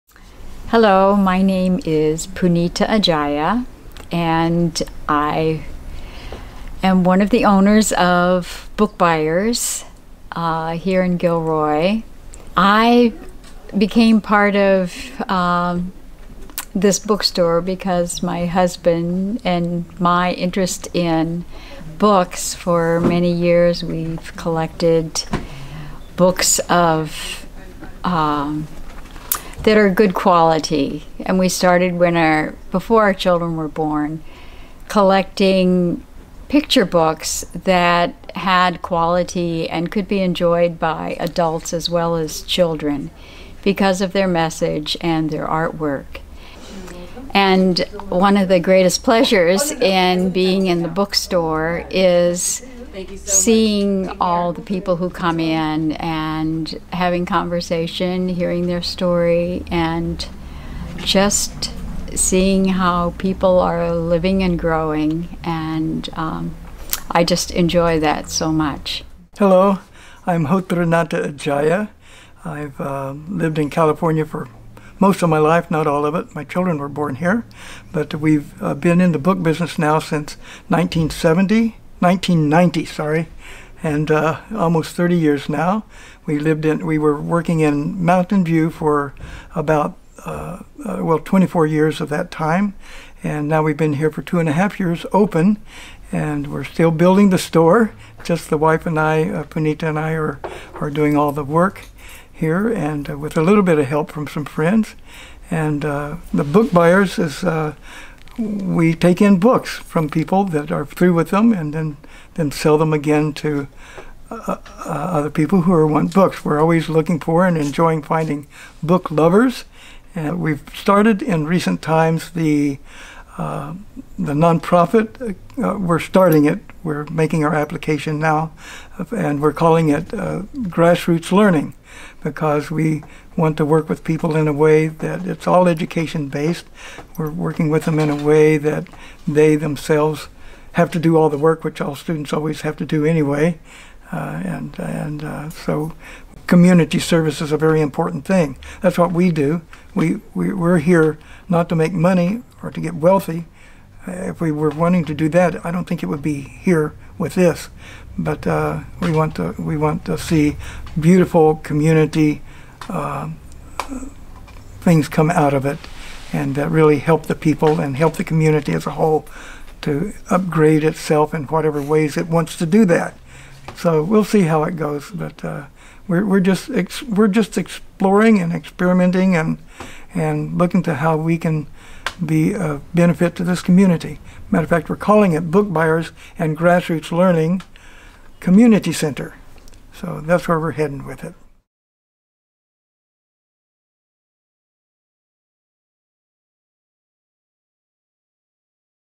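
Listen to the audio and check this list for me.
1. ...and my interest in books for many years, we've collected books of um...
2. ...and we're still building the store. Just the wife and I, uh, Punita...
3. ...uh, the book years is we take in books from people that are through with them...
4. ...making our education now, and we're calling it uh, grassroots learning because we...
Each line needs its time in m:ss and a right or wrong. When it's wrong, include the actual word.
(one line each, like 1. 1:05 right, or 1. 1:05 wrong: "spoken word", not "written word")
1. 0:19 right
2. 1:36 right
3. 1:45 wrong: "buyers", not "years"
4. 2:07 wrong: "application", not "education".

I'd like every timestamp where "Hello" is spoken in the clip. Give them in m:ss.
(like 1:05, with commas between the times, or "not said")
0:00, 1:09.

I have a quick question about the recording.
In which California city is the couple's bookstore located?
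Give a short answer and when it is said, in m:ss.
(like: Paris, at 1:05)
Gilroy, at 0:11.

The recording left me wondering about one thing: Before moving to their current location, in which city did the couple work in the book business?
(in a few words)
Mountain View.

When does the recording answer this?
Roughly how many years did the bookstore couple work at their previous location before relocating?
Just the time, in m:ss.
1:31.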